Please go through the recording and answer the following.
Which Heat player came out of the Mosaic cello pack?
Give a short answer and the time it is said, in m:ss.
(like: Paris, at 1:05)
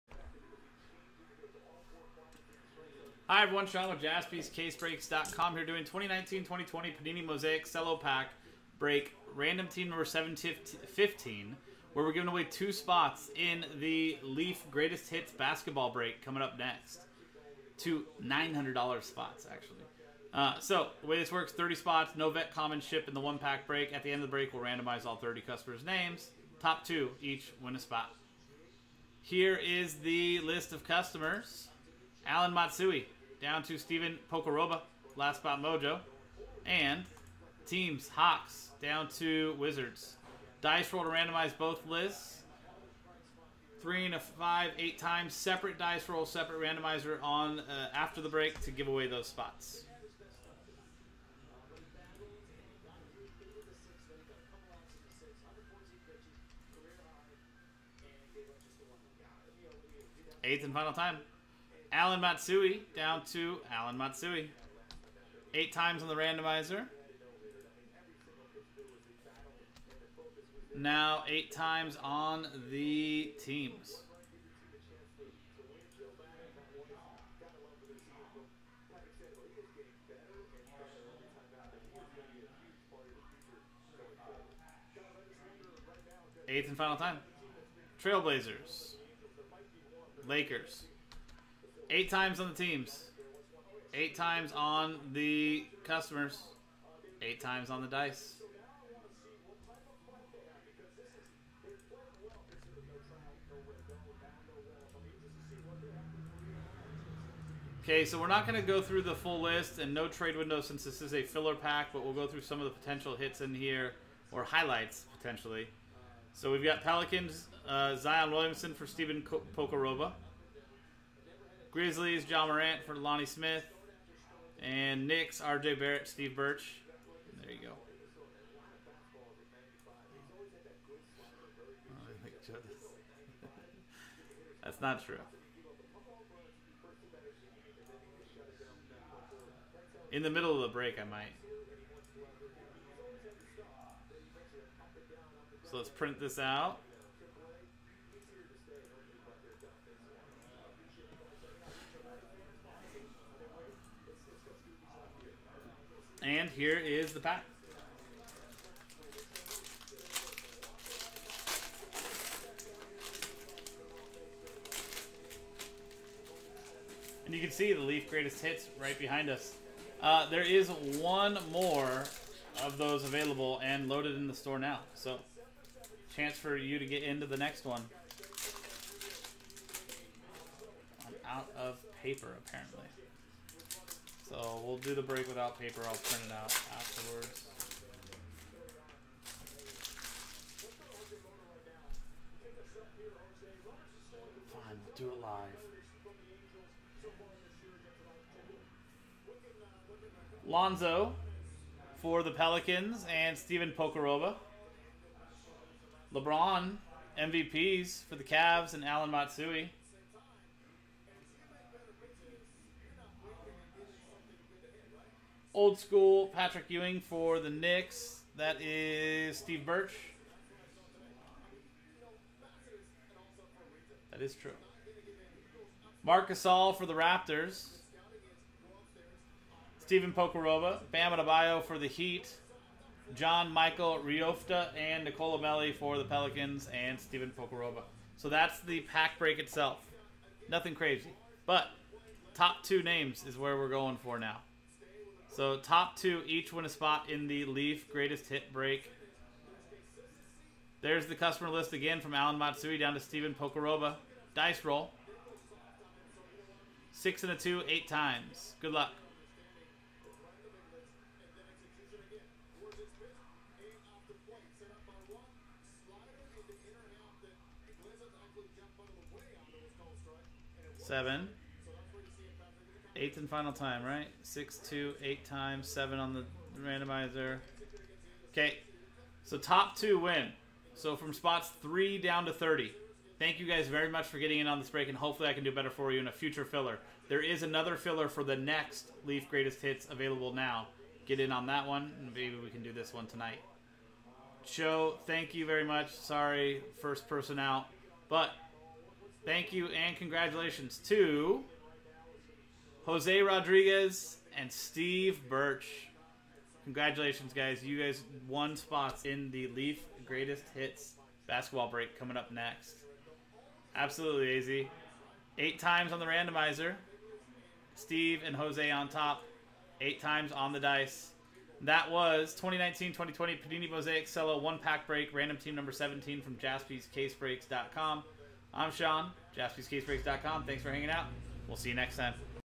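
Bam Adebayo, at 3:50.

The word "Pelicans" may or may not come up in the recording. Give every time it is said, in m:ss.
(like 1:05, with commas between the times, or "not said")
1:56, 3:22, 3:56.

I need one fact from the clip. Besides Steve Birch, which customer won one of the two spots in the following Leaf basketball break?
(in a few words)
Jose Rodriguez.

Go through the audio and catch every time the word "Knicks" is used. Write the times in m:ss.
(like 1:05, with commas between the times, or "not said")
2:05, 3:37.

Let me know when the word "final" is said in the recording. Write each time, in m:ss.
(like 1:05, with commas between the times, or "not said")
1:00, 1:26, 4:33.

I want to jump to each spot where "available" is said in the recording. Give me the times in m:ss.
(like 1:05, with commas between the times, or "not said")
2:53, 4:49.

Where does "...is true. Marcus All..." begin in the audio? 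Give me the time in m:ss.
3:44.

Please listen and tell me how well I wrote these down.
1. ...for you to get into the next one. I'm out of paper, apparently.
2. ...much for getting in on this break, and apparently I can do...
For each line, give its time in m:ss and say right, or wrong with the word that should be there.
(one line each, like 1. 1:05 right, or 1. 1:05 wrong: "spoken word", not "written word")
1. 2:56 right
2. 4:43 wrong: "hopefully", not "apparently".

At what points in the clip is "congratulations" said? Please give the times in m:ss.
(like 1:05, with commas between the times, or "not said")
4:59, 5:06.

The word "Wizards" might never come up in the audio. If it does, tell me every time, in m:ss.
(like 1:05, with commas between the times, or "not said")
0:39.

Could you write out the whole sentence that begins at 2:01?
Grizzlies, Ja Morant for Lonnie Smith.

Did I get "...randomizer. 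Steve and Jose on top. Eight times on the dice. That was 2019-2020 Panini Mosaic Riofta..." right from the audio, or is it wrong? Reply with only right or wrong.
wrong.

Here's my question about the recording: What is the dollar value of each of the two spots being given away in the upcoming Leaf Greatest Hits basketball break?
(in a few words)
$900.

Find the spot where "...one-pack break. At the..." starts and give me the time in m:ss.
0:23.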